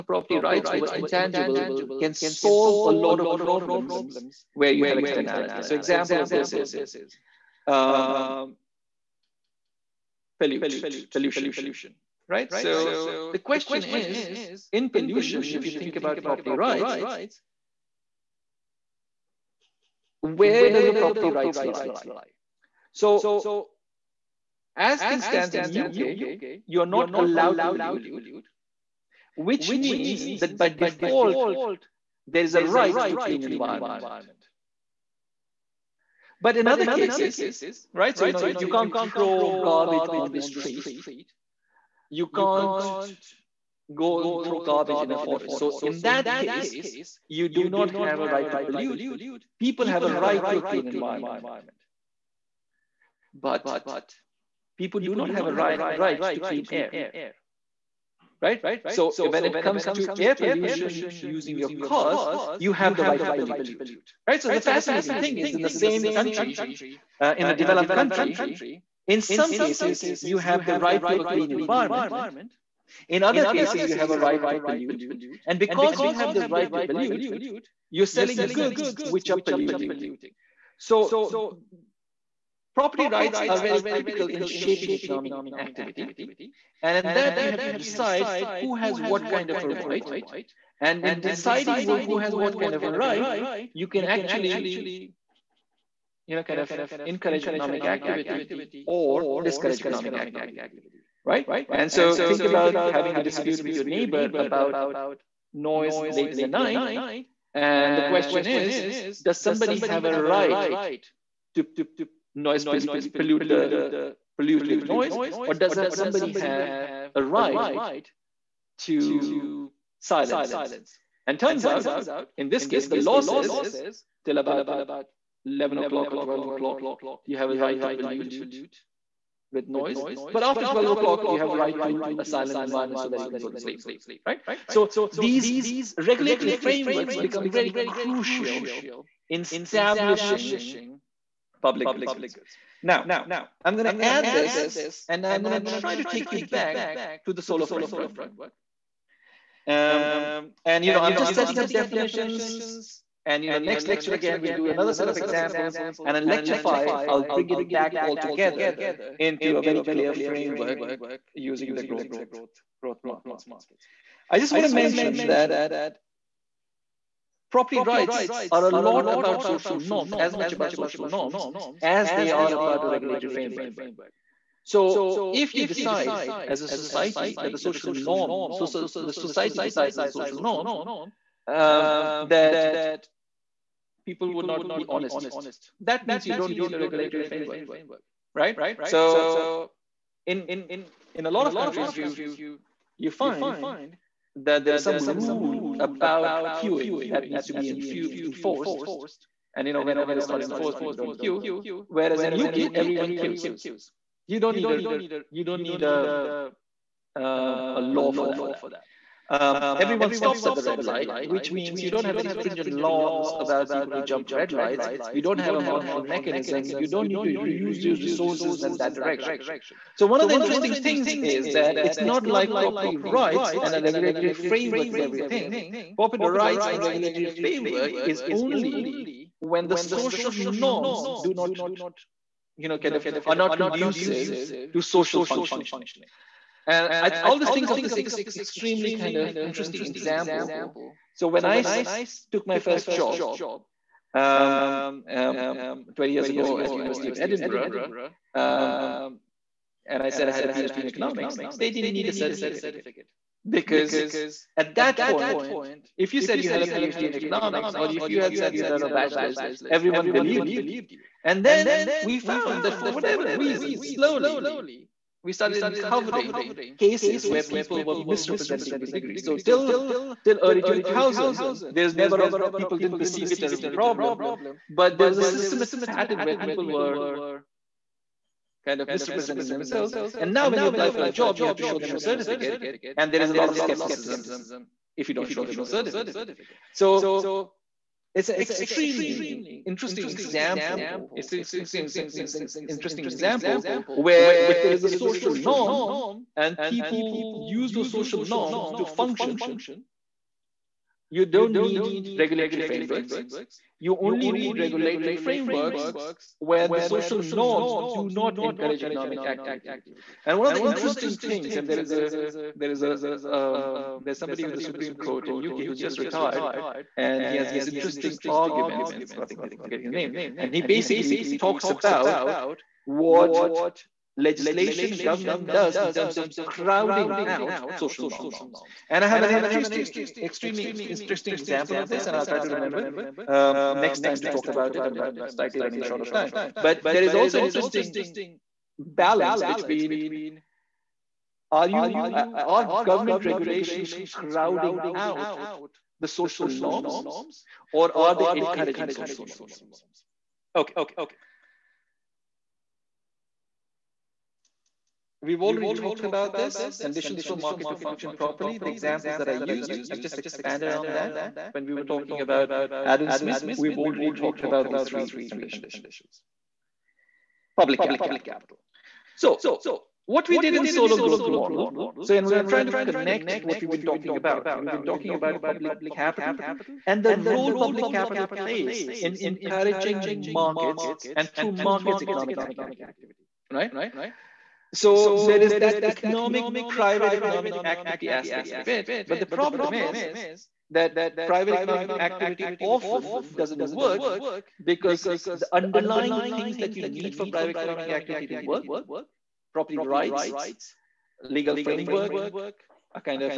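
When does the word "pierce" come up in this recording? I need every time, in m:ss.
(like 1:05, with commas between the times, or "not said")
not said.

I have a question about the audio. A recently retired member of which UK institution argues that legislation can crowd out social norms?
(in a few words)
Supreme Court.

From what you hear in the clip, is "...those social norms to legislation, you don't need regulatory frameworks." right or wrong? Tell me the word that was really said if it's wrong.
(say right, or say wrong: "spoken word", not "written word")
wrong: "function", not "legislation".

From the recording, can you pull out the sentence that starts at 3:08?
So in, in a lot of countries, you, you find that there is some rule about queuing that needs to be enforced.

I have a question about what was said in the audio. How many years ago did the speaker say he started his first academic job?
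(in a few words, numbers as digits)
20 years.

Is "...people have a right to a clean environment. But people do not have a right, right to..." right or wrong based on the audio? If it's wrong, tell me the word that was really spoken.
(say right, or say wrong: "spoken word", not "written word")
right.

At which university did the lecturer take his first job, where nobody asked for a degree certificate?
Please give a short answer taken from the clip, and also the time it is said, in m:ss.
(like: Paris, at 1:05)
University of Edinburgh, at 4:06.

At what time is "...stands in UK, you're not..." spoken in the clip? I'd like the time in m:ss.
0:25.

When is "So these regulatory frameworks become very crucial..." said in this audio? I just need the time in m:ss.
2:14.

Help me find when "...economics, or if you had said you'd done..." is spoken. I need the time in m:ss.
4:17.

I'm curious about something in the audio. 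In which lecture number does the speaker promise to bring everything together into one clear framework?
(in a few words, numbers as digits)
lecture five.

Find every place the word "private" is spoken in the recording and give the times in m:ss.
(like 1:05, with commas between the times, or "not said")
6:26, 6:31, 6:37.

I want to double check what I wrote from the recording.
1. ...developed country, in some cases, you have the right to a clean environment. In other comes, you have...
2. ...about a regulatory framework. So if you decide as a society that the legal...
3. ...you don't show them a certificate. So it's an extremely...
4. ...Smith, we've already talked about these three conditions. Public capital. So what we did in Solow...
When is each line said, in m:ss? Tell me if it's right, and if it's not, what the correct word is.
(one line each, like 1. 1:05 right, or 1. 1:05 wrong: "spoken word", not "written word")
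1. 1:07 wrong: "cases", not "comes"
2. 2:52 wrong: "social", not "legal"
3. 4:45 right
4. 6:03 right.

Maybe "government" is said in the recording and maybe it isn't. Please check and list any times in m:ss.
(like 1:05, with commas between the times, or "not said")
5:24, 5:42.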